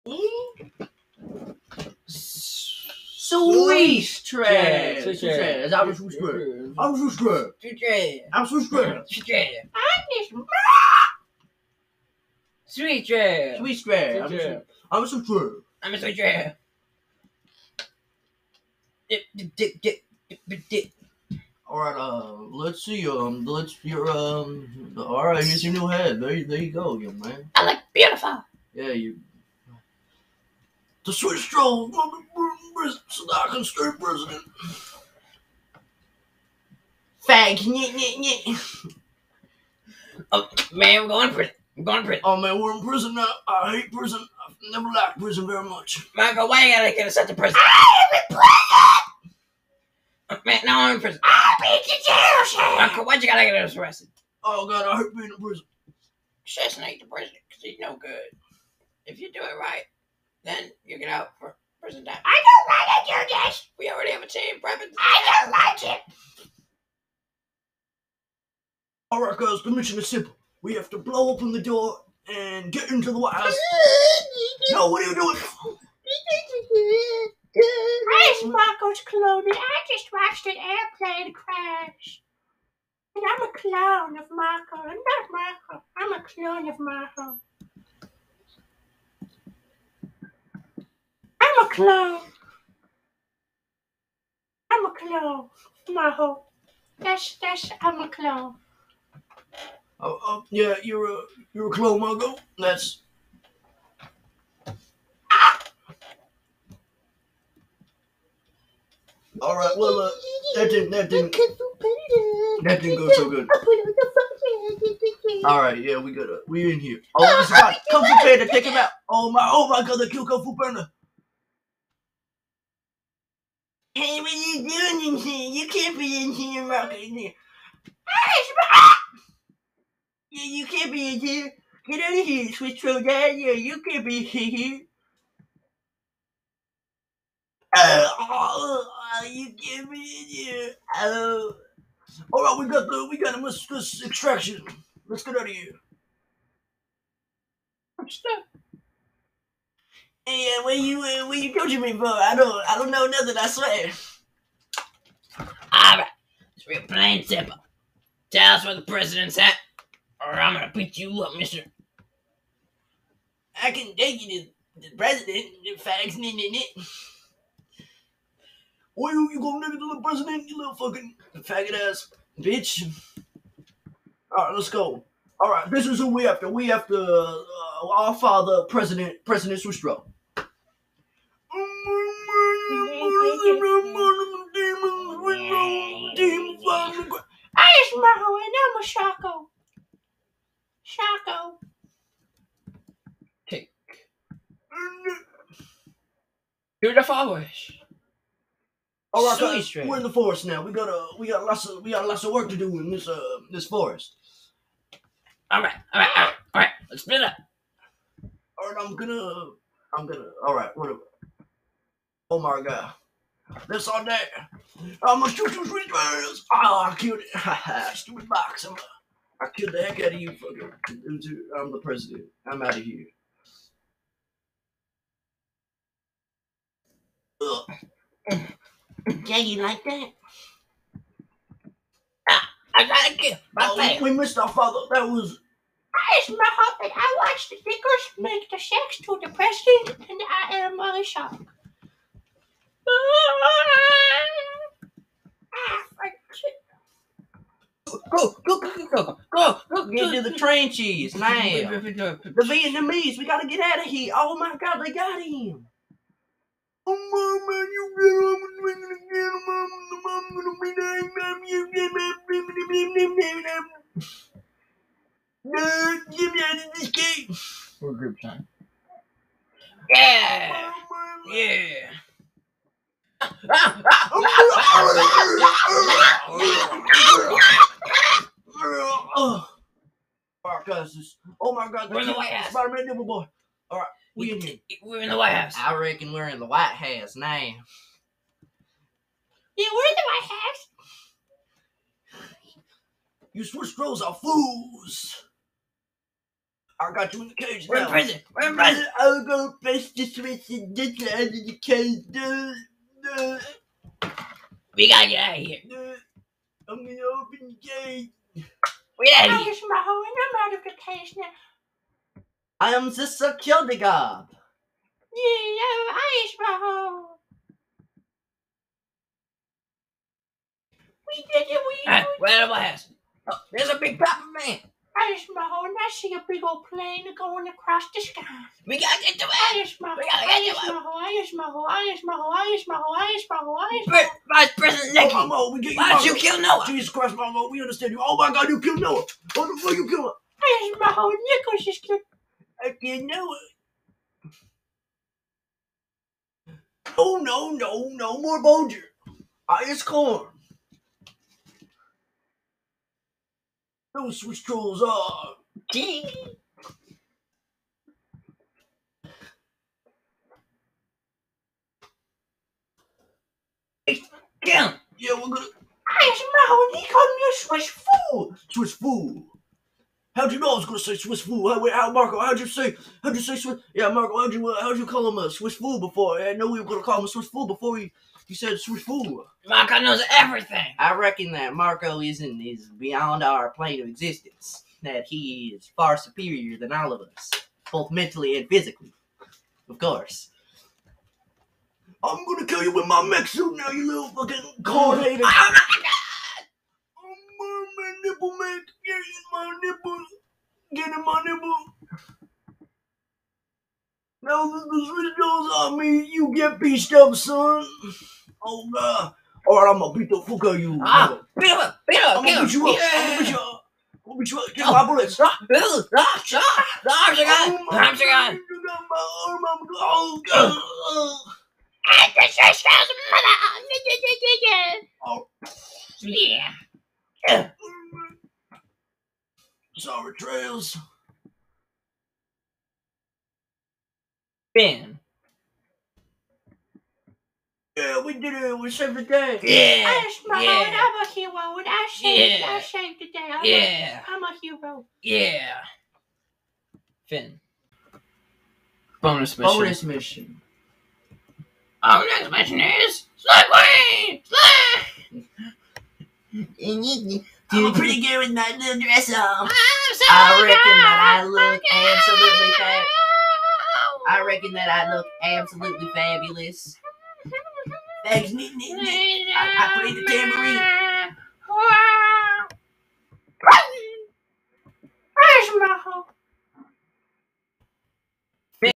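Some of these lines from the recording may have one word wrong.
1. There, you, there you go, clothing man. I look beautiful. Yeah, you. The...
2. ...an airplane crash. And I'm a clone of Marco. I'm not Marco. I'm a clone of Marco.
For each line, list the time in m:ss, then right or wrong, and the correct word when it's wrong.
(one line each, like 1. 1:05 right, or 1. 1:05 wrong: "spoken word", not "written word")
1. 0:26 wrong: "young", not "clothing"
2. 1:20 right.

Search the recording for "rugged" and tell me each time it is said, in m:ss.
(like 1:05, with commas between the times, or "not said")
not said.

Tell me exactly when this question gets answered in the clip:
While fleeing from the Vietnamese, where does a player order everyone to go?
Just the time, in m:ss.
4:10.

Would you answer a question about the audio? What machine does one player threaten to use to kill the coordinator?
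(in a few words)
Mech suit.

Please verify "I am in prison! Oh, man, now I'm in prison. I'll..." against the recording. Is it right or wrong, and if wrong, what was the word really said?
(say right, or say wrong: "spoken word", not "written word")
right.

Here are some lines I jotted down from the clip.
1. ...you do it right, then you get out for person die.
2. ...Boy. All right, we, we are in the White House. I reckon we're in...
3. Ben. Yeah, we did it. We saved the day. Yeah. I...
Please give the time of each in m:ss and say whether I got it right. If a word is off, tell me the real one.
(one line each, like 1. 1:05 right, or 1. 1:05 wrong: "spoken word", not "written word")
1. 0:59 right
2. 4:43 right
3. 7:14 right.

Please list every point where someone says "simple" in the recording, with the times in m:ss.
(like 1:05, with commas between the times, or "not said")
1:10, 2:37.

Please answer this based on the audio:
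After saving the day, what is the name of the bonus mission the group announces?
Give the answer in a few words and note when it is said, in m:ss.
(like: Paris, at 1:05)
Slay Queen, at 7:33.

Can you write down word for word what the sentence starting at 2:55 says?
All right, this is who we after.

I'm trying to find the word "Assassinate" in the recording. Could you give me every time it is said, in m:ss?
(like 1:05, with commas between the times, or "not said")
0:56.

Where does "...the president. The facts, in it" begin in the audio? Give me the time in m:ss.
2:44.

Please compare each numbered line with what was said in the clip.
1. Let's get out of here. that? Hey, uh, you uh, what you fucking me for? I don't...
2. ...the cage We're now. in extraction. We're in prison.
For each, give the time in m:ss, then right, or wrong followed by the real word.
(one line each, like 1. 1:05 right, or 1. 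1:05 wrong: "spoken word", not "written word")
1. 2:25 wrong: "coaching", not "fucking"
2. 4:57 wrong: "prison", not "extraction".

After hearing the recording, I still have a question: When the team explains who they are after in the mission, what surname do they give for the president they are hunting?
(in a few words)
Sustro.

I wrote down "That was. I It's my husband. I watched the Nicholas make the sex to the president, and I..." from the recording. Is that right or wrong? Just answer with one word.
wrong.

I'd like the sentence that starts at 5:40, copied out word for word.
Irish Mahal, Nicholas just killed you know it, No, no, no, no more Bulger.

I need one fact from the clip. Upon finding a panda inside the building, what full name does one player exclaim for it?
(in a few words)
Kyoko Fu Panda.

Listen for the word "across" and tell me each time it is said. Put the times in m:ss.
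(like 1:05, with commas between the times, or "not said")
5:27.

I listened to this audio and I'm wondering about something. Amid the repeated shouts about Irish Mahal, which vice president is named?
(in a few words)
Nicky.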